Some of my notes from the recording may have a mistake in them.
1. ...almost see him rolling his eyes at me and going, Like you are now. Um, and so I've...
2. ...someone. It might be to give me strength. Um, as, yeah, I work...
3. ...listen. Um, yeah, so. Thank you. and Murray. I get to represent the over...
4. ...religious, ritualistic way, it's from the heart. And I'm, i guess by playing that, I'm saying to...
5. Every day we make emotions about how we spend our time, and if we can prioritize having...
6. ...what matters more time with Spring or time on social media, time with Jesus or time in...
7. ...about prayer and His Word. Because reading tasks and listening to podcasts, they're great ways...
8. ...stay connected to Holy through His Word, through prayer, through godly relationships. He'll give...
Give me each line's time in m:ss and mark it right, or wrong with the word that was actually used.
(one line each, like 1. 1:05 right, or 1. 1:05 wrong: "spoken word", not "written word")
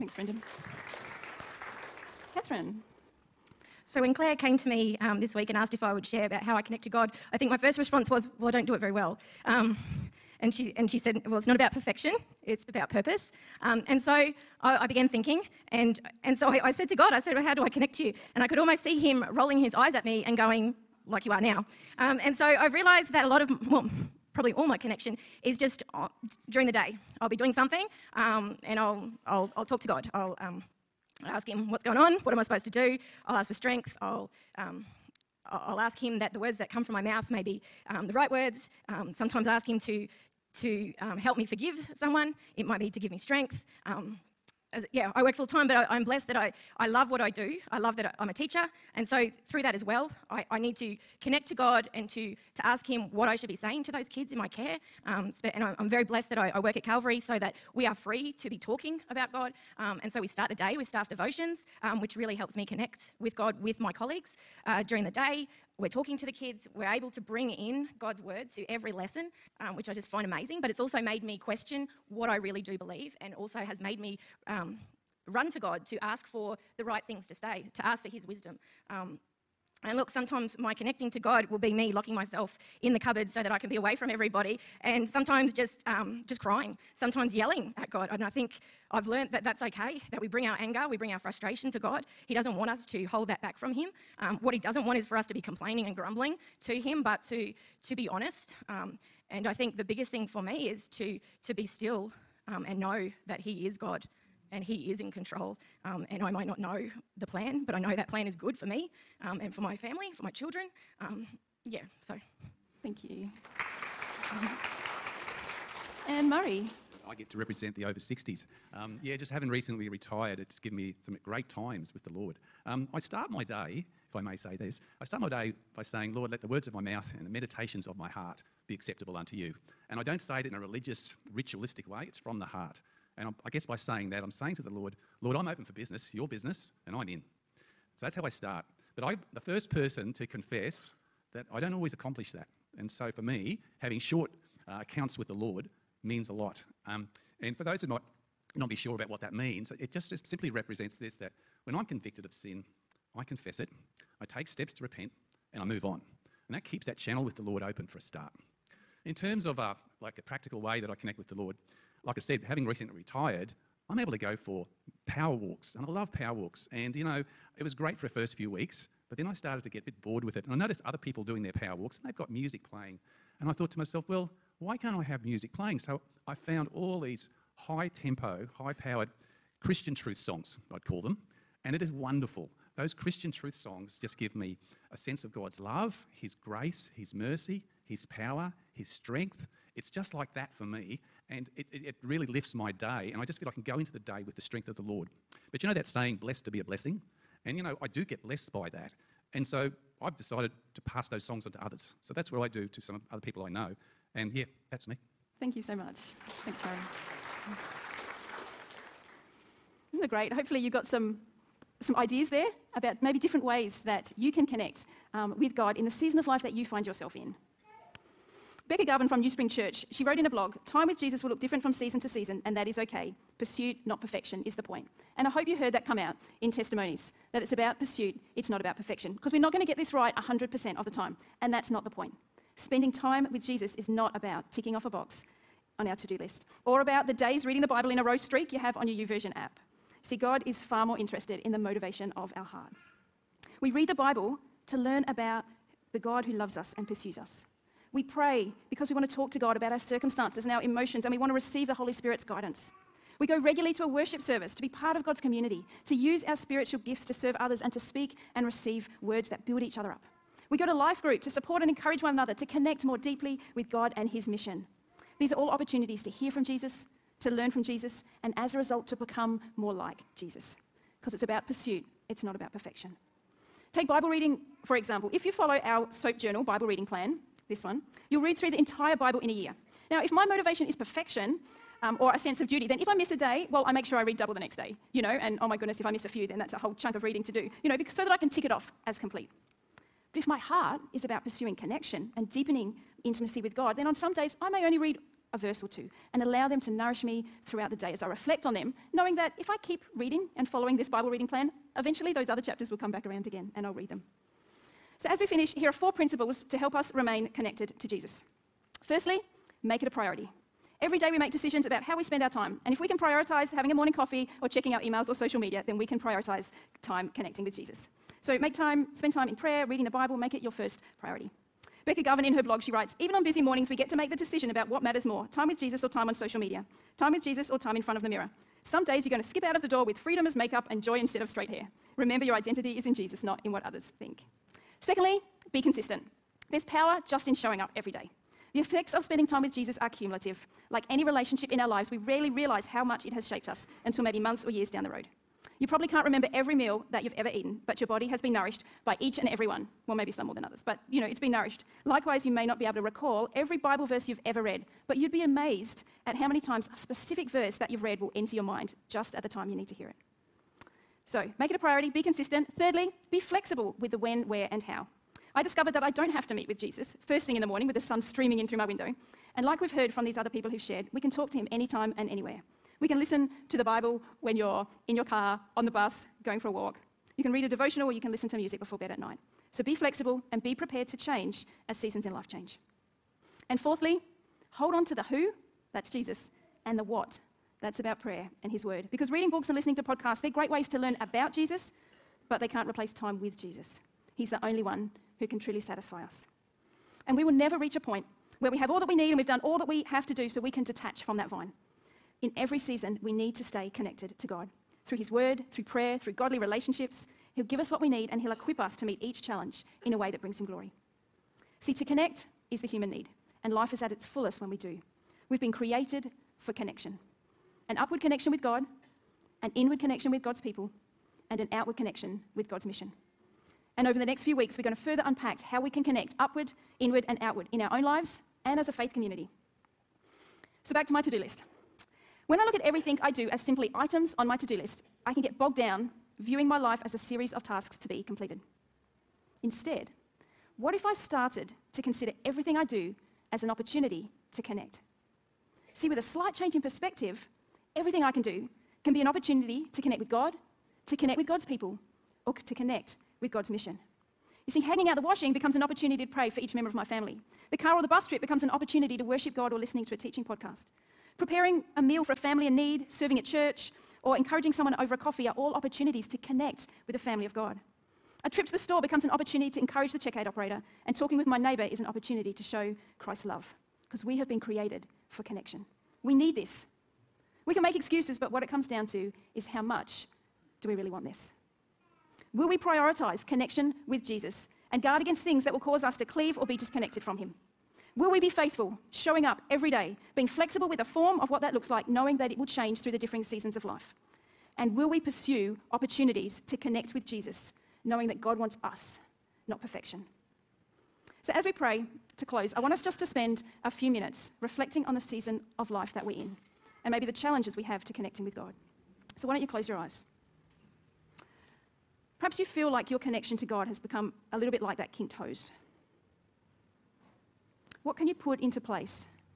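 1. 0:18 right
2. 0:41 right
3. 1:50 wrong: "children", not "listen"
4. 2:10 wrong: "saying", not "playing"
5. 5:10 wrong: "decisions", not "emotions"
6. 5:24 wrong: "Jesus", not "Spring"
7. 6:27 wrong: "books", not "tasks"
8. 6:43 wrong: "God", not "Holy".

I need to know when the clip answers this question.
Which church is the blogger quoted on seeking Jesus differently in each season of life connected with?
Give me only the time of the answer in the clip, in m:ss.
3:39.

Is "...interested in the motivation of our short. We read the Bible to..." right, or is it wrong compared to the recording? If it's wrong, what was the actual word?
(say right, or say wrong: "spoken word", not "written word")
wrong: "heart", not "short".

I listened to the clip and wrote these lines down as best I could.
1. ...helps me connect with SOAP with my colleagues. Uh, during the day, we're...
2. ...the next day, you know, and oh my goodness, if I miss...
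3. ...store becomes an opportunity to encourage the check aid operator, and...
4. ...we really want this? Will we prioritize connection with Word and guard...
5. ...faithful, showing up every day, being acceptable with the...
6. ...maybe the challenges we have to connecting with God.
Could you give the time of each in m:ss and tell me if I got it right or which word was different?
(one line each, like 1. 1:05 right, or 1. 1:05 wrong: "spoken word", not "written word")
1. 1:02 wrong: "God", not "SOAP"
2. 4:44 right
3. 7:48 right
4. 8:00 wrong: "Jesus", not "Word"
5. 8:08 wrong: "flexible", not "acceptable"
6. 8:26 right.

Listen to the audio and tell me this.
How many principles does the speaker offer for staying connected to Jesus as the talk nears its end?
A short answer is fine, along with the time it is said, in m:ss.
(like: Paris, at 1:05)
4, at 5:05.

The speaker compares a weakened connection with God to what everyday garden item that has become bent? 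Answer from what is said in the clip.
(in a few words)
Kinked hose.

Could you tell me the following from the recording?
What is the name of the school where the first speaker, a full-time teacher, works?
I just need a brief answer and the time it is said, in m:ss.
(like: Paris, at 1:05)
Calvary, at 0:56.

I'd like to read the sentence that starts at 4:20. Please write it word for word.
We go to life group to support and encourage one another, to connect more deeply with God and His mission.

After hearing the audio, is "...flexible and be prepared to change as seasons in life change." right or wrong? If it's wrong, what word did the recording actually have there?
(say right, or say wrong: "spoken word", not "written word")
right.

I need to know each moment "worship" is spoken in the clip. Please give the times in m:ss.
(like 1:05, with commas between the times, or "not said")
4:13, 7:39.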